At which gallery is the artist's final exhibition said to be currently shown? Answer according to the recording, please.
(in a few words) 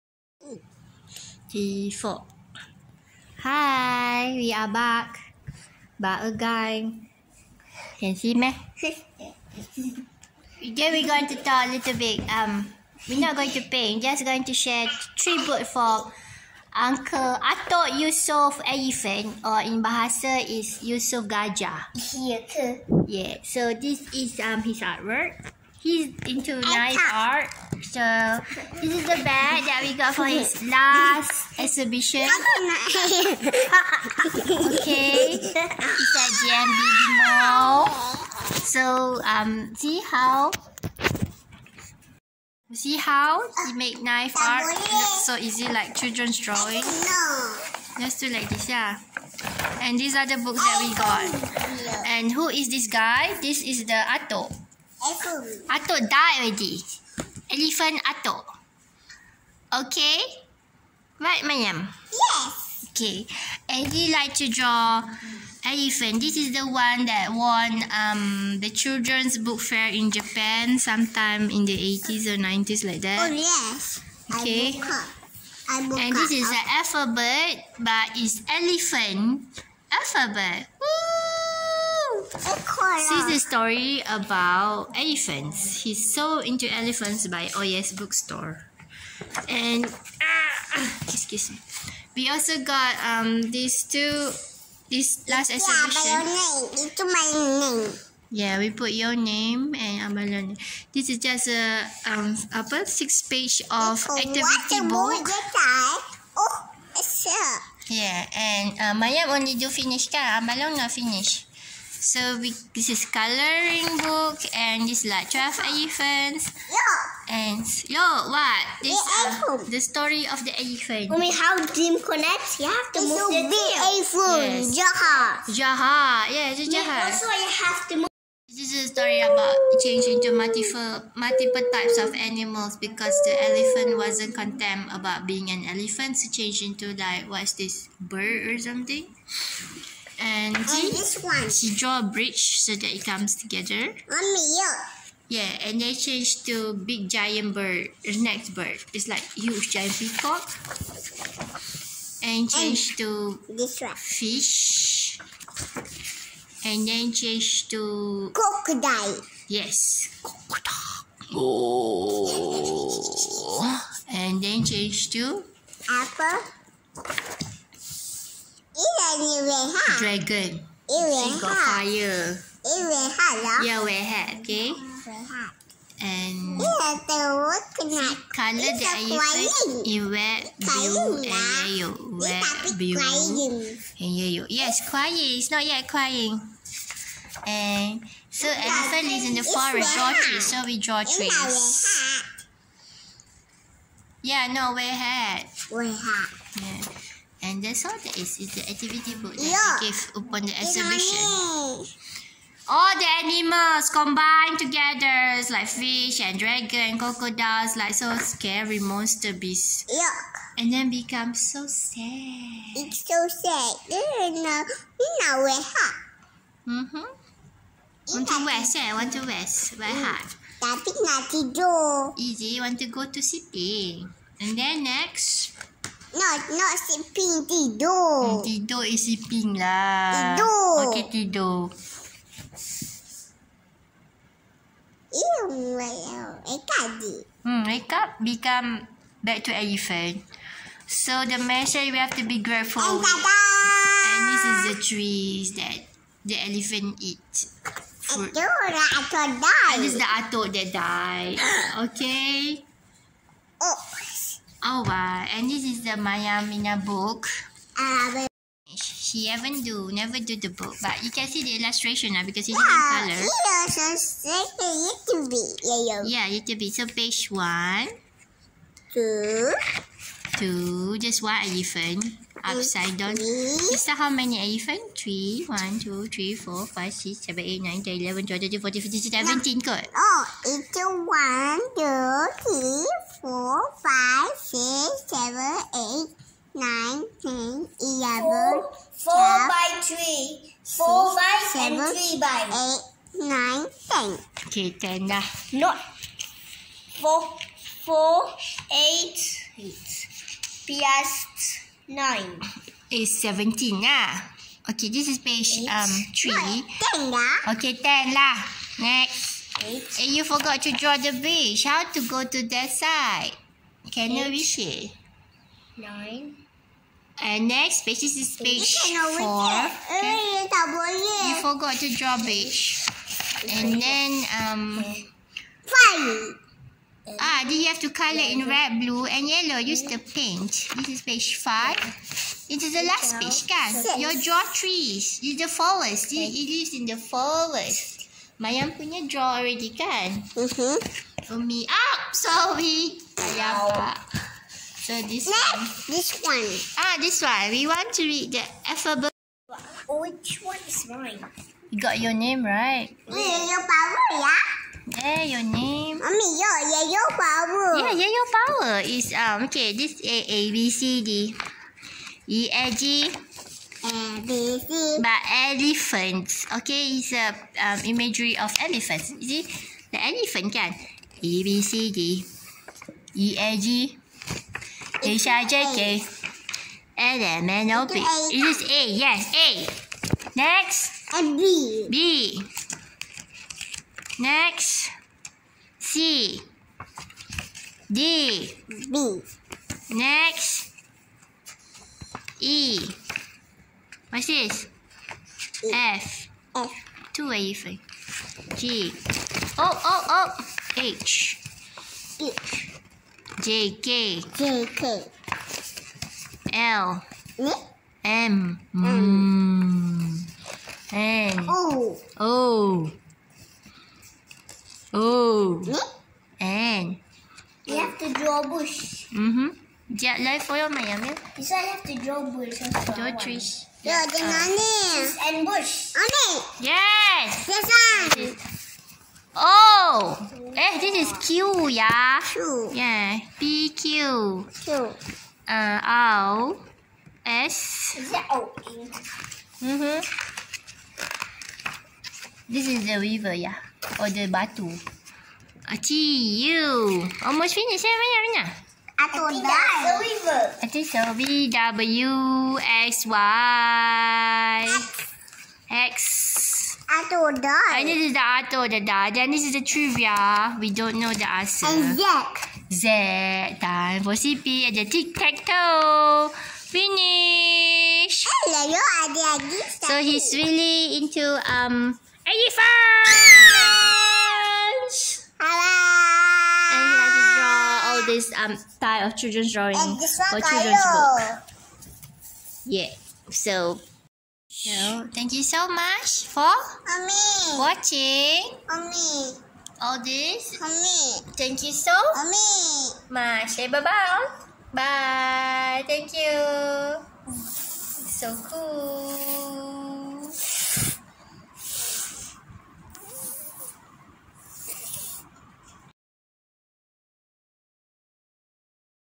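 GMB.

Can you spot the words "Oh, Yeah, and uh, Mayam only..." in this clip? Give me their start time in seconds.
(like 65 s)
106 s.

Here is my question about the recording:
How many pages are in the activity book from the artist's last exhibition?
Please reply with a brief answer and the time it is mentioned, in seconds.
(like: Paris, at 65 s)
6, at 102 s.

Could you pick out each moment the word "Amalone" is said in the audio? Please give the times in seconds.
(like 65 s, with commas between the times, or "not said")
100 s, 110 s.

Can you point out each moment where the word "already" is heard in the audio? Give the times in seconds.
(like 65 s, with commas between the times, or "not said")
56 s, 339 s.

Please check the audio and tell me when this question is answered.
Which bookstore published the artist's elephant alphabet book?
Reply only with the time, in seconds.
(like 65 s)
87 s.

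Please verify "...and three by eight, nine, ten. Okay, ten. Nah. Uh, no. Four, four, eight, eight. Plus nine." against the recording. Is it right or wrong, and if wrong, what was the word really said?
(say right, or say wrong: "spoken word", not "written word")
right.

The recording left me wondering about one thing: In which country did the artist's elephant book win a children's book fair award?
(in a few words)
Japan.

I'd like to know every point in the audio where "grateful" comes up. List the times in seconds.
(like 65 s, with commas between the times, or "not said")
242 s.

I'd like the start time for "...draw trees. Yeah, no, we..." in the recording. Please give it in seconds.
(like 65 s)
190 s.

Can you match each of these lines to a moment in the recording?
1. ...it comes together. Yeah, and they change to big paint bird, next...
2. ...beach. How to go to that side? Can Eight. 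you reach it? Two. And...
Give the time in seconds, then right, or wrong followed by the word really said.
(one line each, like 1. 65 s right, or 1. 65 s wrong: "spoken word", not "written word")
1. 142 s wrong: "giant", not "paint"
2. 311 s wrong: "Nine", not "Two".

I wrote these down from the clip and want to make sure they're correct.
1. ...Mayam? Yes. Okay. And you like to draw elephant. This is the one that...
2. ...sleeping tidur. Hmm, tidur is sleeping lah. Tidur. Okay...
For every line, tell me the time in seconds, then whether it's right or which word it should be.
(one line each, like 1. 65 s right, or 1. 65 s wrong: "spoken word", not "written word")
1. 61 s right
2. 226 s right.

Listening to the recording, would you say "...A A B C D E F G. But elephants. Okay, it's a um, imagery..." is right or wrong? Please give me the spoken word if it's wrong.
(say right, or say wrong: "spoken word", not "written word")
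right.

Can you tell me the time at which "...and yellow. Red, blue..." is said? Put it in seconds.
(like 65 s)
181 s.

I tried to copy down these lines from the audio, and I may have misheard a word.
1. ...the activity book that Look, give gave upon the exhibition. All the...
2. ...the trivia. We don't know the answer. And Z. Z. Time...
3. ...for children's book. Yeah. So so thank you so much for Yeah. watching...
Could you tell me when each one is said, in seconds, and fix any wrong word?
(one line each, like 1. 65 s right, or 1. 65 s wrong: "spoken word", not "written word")
1. 198 s right
2. 459 s right
3. 479 s wrong: "Mommy", not "Yeah".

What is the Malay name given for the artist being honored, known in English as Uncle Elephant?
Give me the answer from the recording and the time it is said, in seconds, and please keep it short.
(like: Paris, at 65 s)
Yusof Gajah, at 20 s.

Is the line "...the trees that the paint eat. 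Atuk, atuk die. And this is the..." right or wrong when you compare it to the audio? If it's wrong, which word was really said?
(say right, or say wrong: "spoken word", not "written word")
wrong: "elephant", not "paint".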